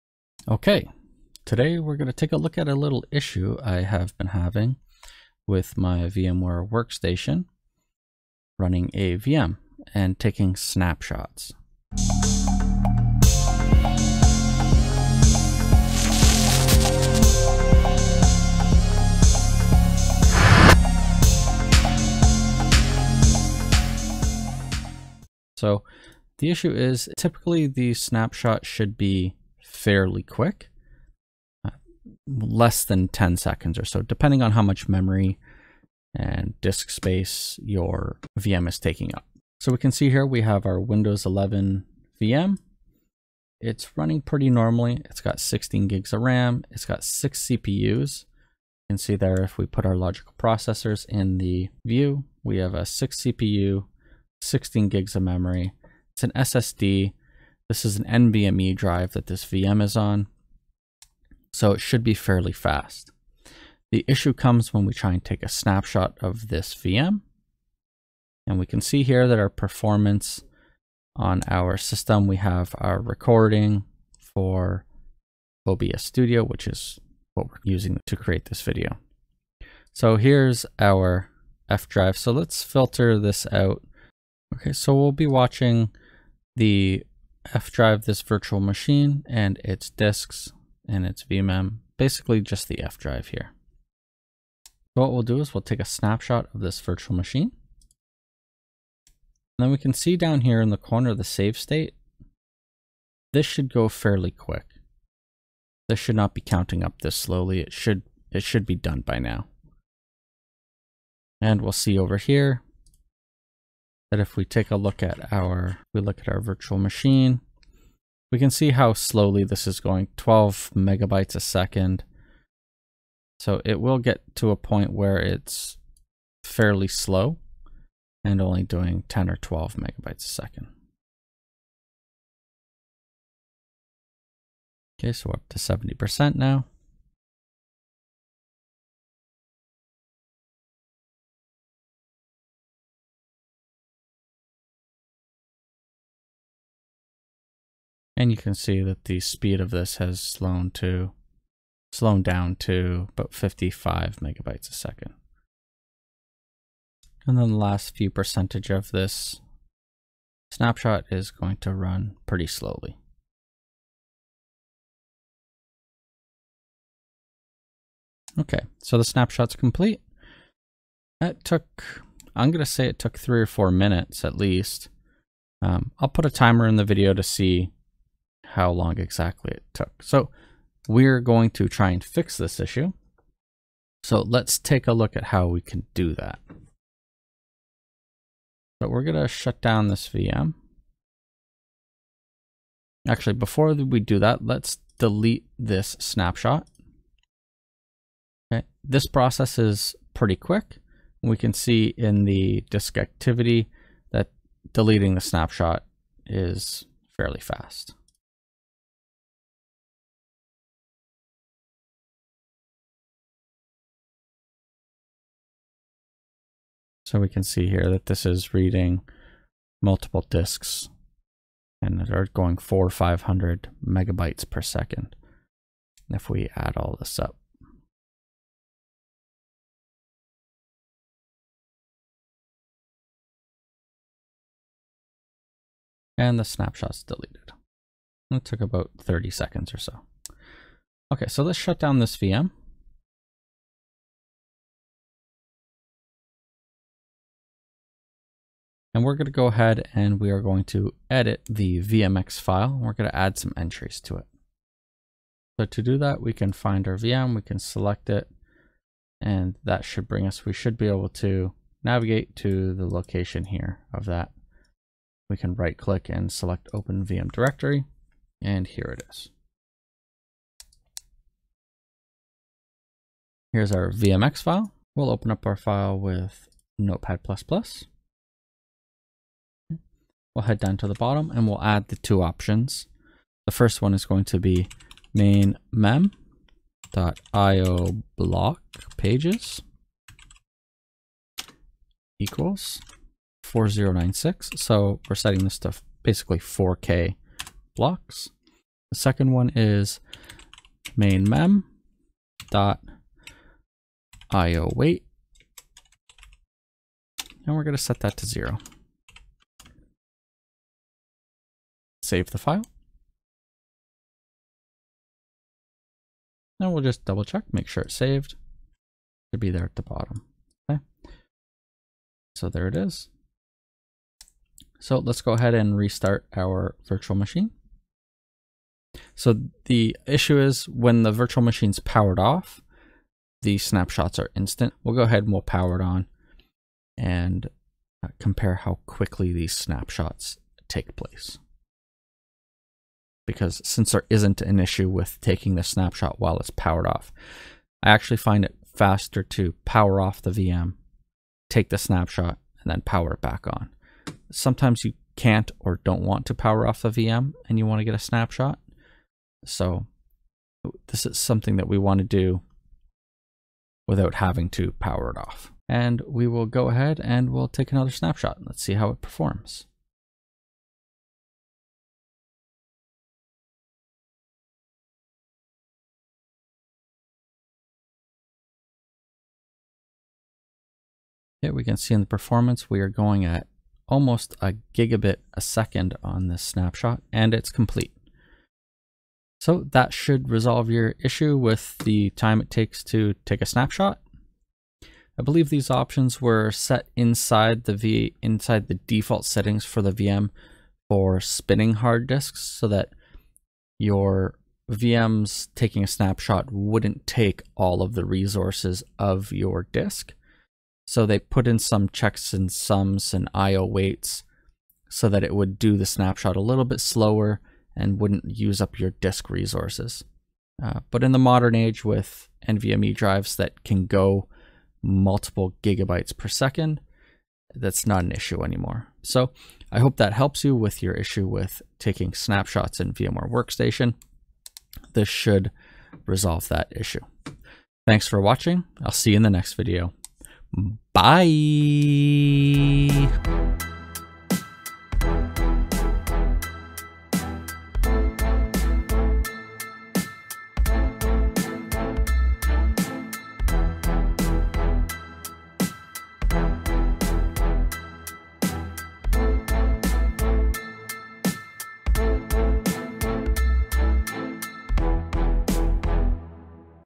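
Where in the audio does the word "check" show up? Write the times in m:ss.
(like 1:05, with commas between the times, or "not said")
5:17, 6:51.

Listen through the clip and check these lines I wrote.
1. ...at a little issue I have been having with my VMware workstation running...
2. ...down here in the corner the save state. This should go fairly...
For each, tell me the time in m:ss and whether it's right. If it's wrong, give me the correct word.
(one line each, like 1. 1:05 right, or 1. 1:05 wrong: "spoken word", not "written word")
1. 0:02 right
2. 1:40 right.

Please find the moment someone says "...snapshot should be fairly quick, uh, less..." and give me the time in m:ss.
0:27.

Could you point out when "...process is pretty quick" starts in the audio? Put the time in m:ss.
3:19.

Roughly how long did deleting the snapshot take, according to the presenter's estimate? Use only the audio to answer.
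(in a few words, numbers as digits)
30 seconds.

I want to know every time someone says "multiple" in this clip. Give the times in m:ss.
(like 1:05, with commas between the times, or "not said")
3:39, 7:04.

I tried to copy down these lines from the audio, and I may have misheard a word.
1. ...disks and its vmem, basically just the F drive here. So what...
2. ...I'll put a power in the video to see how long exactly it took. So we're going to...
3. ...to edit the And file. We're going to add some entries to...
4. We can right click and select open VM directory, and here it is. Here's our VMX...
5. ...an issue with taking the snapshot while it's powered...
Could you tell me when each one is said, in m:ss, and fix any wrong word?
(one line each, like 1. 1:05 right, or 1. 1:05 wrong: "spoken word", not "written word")
1. 1:29 right
2. 2:55 wrong: "timer", not "power"
3. 4:10 wrong: "VMX", not "And"
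4. 4:25 right
5. 5:44 right.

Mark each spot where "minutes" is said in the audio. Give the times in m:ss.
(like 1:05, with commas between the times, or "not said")
2:53.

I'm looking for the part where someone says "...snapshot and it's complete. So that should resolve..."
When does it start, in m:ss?
6:26.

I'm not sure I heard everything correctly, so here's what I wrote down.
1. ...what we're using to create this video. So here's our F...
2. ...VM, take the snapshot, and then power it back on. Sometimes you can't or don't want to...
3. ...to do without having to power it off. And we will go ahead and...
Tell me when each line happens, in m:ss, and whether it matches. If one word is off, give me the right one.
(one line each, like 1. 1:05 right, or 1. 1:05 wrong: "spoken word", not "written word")
1. 1:17 right
2. 5:50 right
3. 6:01 right.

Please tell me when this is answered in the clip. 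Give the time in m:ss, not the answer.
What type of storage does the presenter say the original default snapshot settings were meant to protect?
6:41.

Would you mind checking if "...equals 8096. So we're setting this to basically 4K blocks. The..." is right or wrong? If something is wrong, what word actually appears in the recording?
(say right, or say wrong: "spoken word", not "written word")
wrong: "4096", not "8096".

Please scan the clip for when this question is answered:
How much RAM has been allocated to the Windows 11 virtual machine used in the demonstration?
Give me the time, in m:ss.
0:45.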